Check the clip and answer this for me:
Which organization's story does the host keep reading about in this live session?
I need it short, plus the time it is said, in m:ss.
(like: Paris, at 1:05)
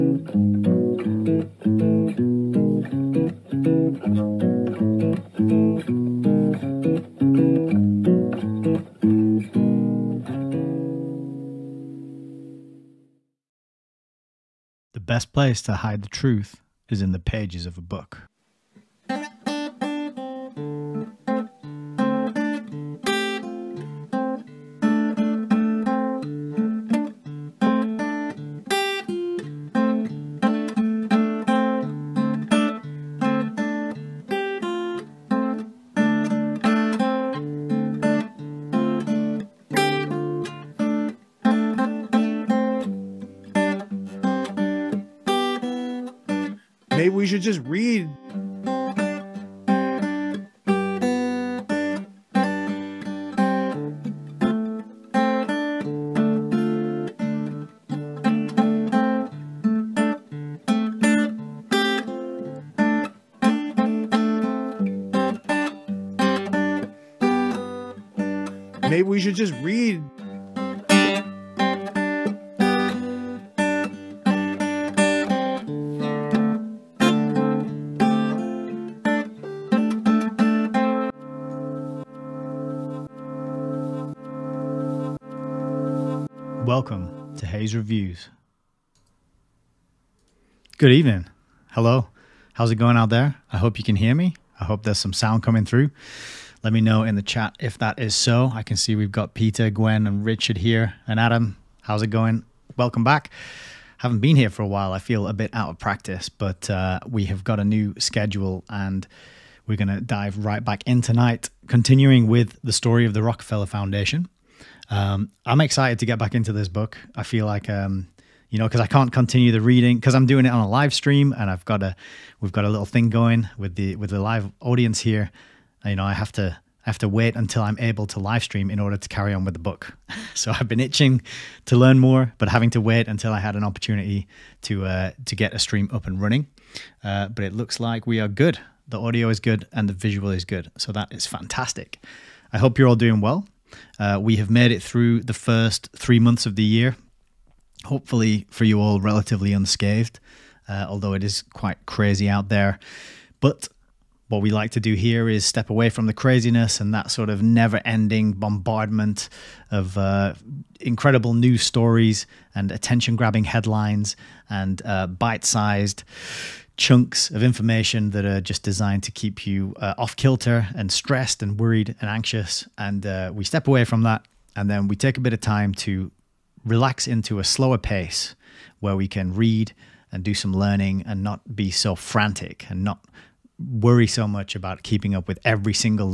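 Rockefeller Foundation, at 1:53.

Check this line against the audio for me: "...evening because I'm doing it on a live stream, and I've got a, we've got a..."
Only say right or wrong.
wrong.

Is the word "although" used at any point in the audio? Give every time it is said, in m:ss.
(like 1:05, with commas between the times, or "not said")
2:30.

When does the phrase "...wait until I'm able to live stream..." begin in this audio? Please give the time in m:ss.
2:07.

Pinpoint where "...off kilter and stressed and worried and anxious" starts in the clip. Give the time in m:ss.
2:49.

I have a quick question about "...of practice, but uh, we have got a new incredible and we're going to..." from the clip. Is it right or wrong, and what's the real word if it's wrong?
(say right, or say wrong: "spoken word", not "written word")
wrong: "schedule", not "incredible".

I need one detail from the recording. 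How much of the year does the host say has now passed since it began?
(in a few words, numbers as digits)
3 months.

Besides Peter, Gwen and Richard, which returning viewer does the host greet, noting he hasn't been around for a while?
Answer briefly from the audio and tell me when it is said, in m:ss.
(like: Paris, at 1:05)
Adam, at 1:41.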